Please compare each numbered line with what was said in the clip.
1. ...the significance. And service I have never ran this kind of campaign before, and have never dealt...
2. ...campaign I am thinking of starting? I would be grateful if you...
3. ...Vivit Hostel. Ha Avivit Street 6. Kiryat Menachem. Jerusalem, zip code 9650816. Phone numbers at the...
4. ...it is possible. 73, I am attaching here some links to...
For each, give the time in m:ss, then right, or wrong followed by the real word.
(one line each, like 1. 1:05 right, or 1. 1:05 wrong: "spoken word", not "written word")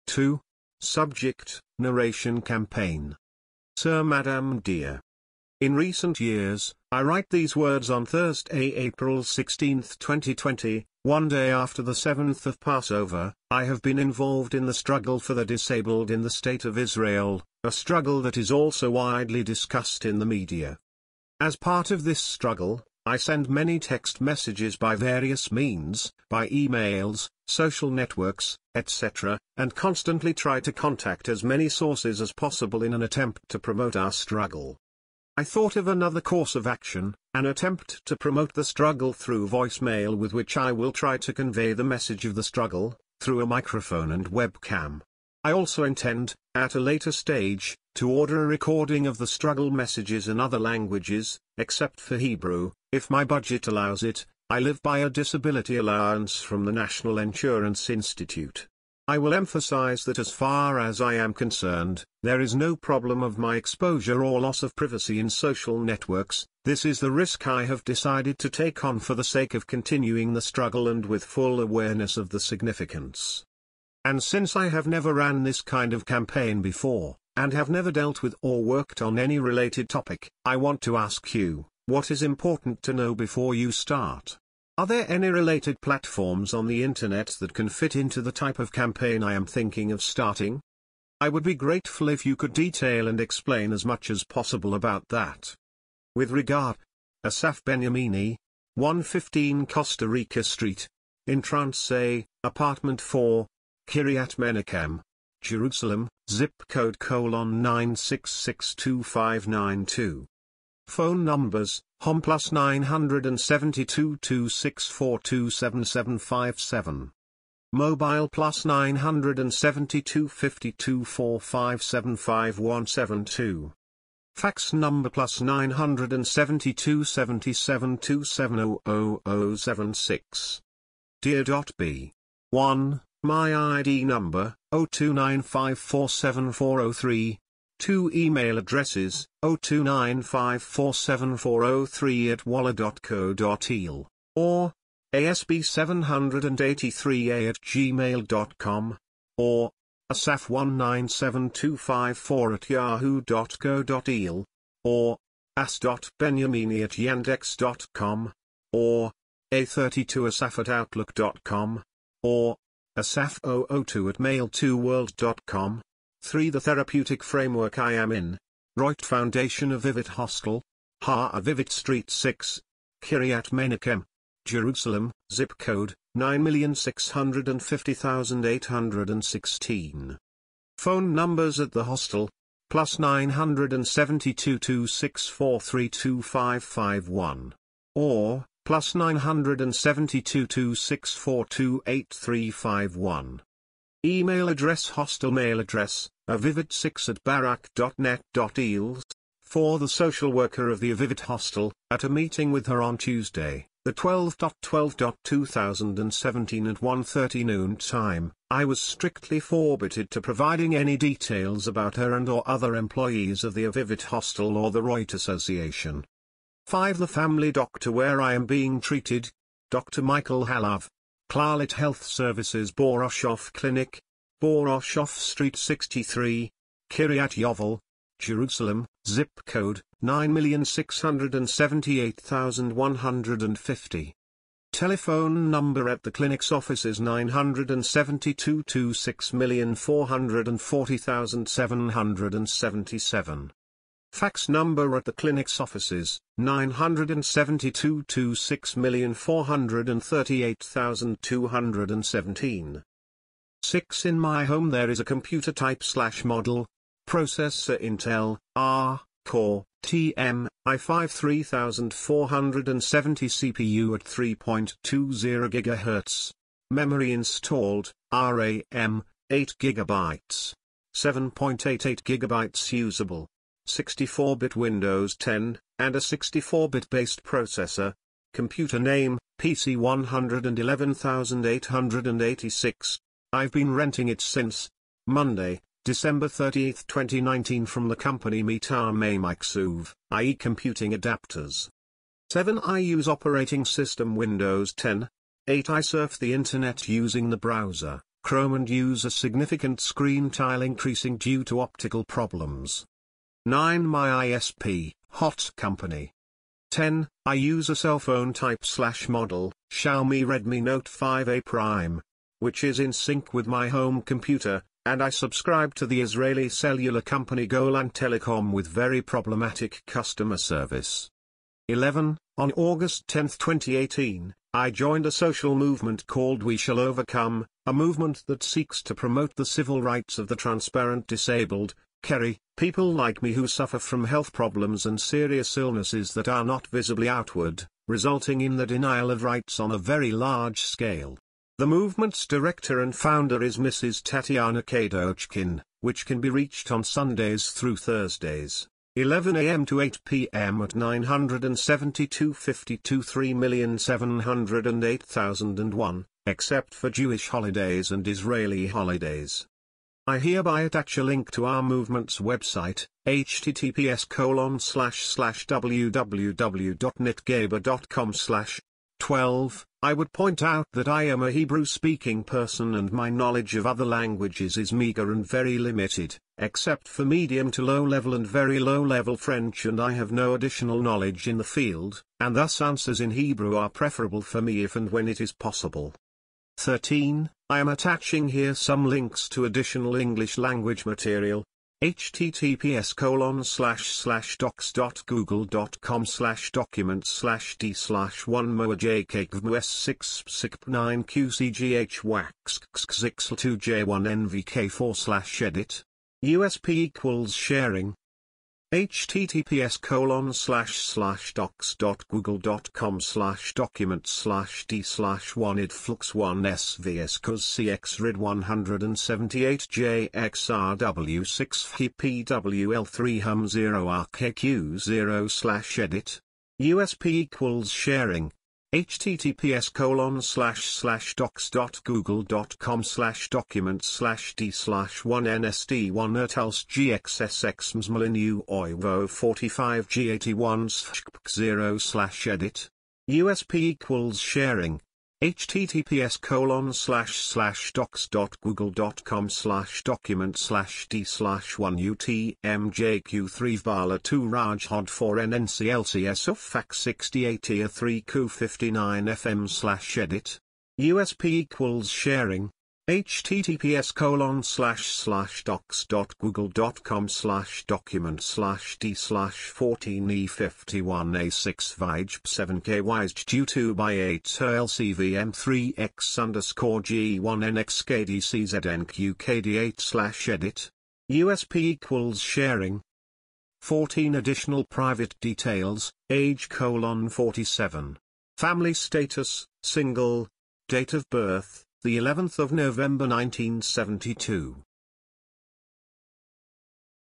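1. 1:12 wrong: "since", not "service"
2. 1:28 right
3. 2:49 right
4. 6:25 wrong: "13", not "73".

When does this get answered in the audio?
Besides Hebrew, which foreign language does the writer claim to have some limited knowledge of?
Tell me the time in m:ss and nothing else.
6:19.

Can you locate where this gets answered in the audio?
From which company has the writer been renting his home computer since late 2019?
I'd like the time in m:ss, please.
4:48.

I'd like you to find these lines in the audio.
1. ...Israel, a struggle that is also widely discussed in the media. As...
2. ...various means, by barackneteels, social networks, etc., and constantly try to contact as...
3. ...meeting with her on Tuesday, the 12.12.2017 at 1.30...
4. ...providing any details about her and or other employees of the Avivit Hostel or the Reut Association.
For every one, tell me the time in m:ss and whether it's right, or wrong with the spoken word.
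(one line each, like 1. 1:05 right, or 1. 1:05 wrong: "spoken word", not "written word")
1. 0:16 right
2. 0:24 wrong: "emails", not "barackneteels"
3. 3:22 right
4. 3:30 right.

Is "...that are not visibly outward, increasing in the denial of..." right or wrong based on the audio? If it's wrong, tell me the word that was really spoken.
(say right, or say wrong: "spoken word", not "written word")
wrong: "resulting", not "increasing".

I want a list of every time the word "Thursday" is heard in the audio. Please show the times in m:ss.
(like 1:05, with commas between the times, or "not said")
0:08, 5:47.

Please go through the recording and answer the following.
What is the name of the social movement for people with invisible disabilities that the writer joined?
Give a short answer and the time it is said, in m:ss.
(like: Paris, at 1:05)
We Shall Overcome, at 5:26.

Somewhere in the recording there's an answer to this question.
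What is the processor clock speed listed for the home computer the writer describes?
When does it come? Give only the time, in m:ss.
4:24.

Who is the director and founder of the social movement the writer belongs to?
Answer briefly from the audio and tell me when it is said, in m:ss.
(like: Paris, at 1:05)
Tatiana Kadochkin, at 5:44.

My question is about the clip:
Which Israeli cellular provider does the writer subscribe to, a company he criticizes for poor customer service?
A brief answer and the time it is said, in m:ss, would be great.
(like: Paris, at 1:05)
Golan Telecom, at 5:17.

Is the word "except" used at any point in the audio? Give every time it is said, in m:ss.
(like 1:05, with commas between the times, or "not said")
0:51, 5:56, 6:16.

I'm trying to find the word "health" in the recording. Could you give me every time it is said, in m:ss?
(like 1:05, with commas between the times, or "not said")
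3:41, 5:34.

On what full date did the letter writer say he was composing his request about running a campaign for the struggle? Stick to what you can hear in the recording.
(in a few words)
April 16, 2020.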